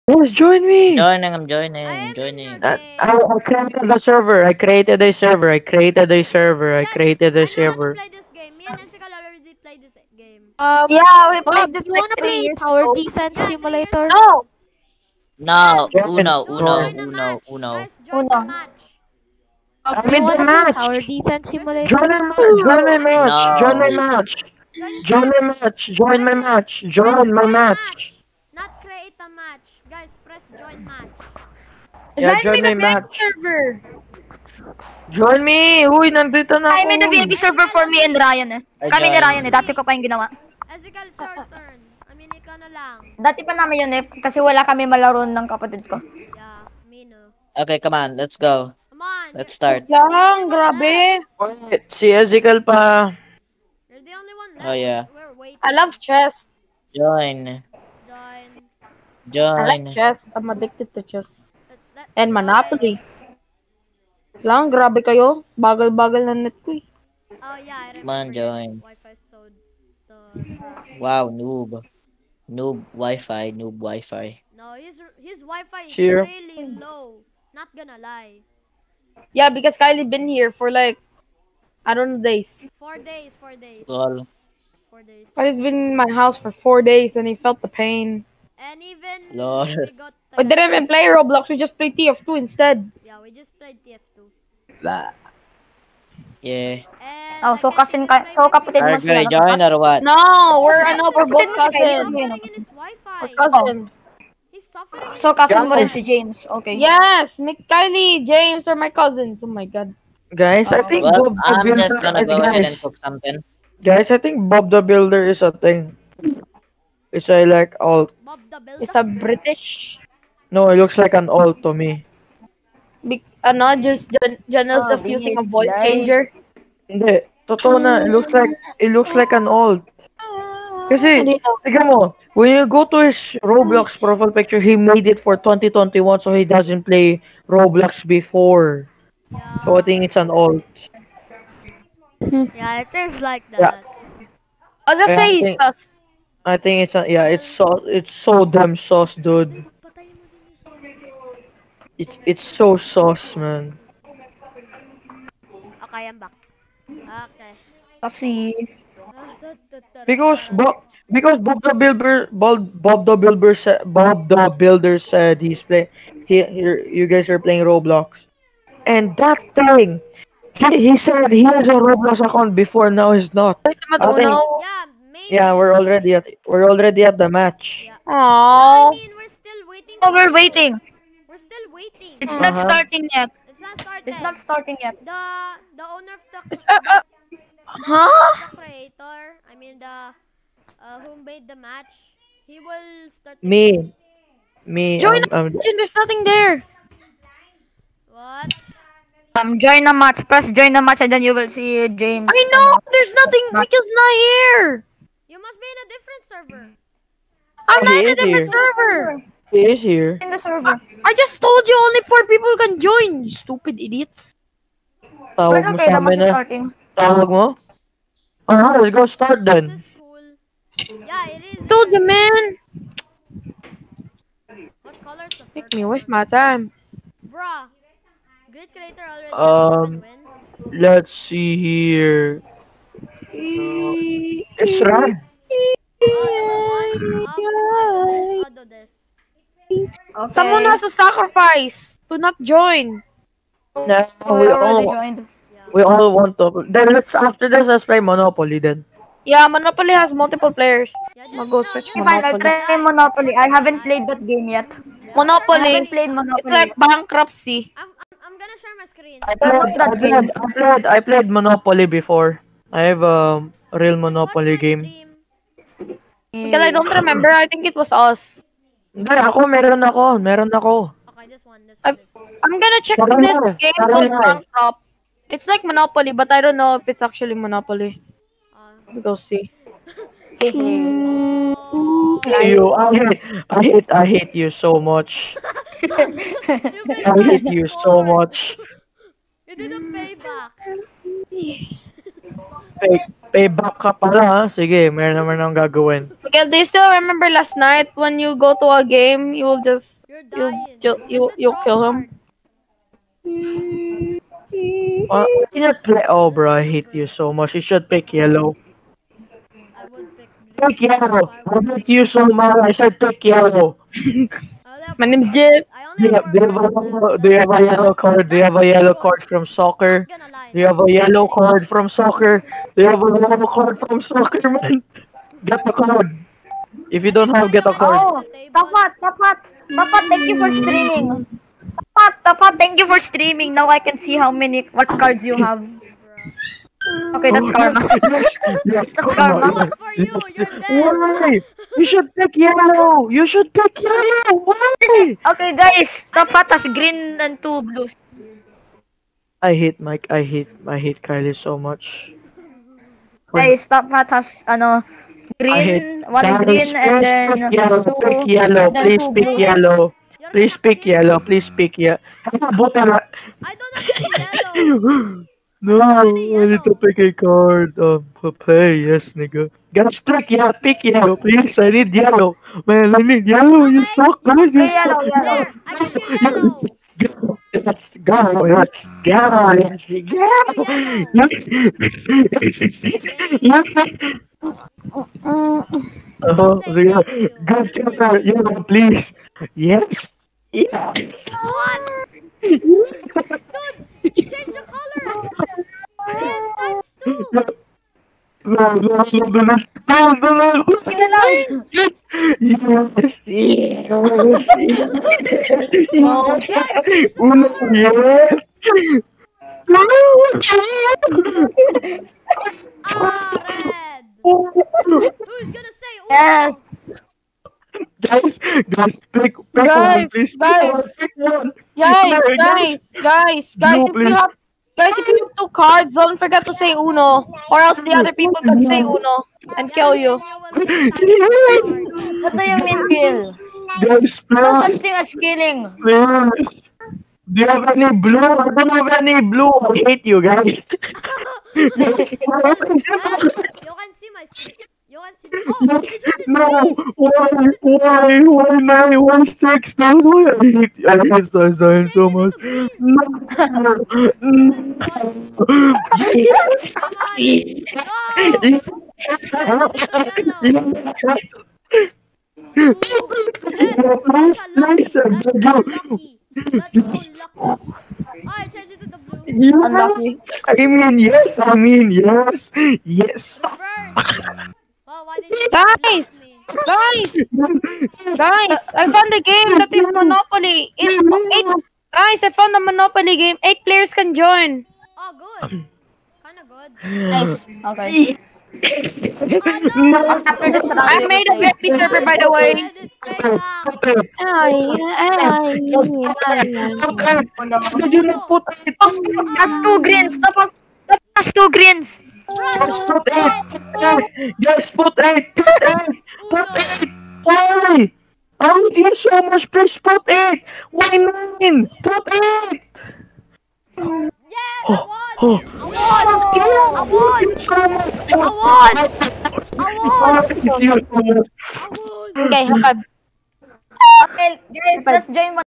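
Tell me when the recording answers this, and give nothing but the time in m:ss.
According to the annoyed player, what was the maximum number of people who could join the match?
3:31.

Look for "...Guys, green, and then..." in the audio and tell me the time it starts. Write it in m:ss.
5:56.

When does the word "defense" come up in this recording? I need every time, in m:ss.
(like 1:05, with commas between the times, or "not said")
0:12, 0:21.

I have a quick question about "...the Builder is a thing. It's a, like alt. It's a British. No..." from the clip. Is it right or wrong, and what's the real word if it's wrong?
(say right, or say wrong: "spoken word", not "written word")
right.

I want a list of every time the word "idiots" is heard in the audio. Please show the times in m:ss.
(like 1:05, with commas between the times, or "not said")
3:33.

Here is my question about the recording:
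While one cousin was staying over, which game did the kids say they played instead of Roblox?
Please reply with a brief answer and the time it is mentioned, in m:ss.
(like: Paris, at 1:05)
TF2, at 1:31.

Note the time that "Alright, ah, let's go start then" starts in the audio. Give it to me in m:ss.
3:38.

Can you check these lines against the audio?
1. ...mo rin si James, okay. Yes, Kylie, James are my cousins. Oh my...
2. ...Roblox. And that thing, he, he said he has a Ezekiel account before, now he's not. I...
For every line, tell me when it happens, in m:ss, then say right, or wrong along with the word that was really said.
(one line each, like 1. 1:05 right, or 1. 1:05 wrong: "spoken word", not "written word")
1. 1:45 right
2. 2:47 wrong: "Roblox", not "Ezekiel".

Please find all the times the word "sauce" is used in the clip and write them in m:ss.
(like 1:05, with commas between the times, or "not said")
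2:28, 2:32.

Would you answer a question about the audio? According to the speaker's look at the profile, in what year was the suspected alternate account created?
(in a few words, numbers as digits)
2021.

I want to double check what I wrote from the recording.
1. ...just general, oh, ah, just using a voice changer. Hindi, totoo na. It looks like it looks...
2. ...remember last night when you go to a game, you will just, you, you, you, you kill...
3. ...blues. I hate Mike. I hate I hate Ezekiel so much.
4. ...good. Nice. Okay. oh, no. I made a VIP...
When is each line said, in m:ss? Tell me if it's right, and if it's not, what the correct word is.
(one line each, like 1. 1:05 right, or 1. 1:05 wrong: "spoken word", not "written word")
1. 2:03 right
2. 4:56 right
3. 5:47 wrong: "Kylie", not "Ezekiel"
4. 8:06 right.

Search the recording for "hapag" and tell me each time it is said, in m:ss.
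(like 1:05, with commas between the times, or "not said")
8:42.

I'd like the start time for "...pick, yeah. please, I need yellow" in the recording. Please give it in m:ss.
6:10.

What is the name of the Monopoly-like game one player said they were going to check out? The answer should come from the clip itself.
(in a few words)
Bankrupt.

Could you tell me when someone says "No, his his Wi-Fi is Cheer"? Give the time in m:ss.
1:14.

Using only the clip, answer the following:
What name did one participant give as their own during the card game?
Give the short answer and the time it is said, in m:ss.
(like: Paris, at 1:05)
Jip, at 5:14.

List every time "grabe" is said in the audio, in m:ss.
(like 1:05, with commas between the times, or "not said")
0:50, 1:04.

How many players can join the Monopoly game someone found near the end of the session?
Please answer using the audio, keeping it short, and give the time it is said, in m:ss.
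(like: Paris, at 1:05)
8, at 8:03.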